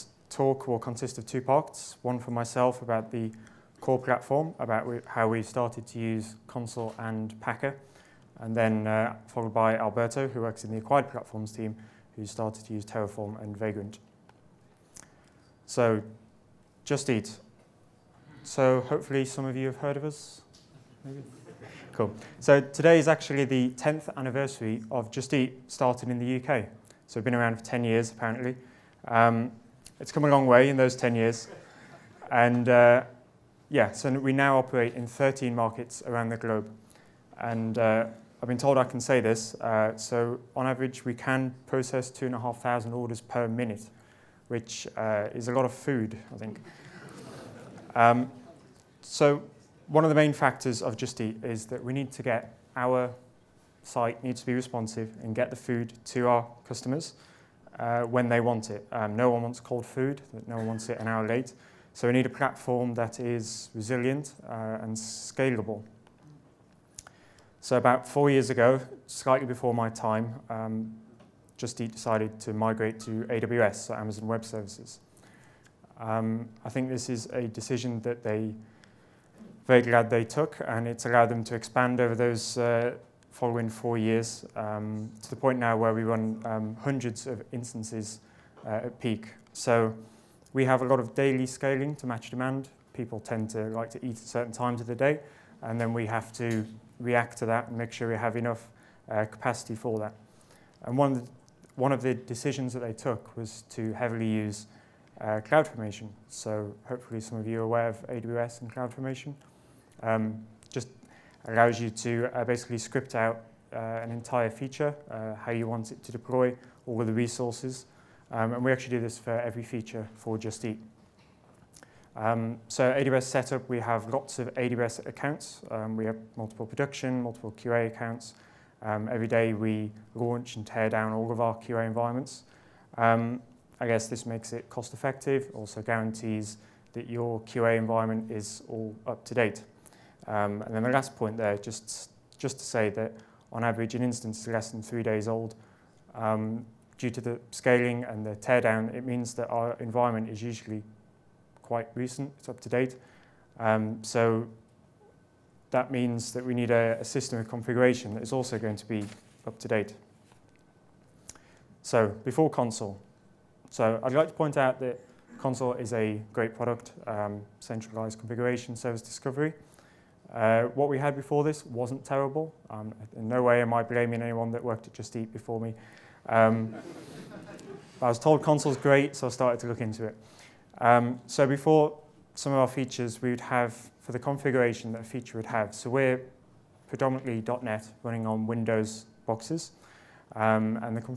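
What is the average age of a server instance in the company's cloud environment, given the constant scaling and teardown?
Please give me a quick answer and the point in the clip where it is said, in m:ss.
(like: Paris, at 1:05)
less than three days, at 2:24.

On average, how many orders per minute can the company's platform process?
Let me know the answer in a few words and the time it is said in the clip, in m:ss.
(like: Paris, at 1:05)
2,500, at 0:42.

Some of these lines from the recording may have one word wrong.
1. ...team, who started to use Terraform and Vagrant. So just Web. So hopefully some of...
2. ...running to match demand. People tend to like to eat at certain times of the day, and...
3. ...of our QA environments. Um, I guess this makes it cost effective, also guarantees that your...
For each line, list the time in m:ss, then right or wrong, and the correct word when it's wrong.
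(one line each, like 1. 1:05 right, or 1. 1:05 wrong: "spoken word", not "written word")
1. 0:11 wrong: "Eat", not "Web"
2. 1:31 wrong: "scaling", not "running"
3. 2:11 right.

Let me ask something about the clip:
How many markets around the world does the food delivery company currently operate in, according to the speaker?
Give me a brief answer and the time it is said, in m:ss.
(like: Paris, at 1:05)
13, at 0:35.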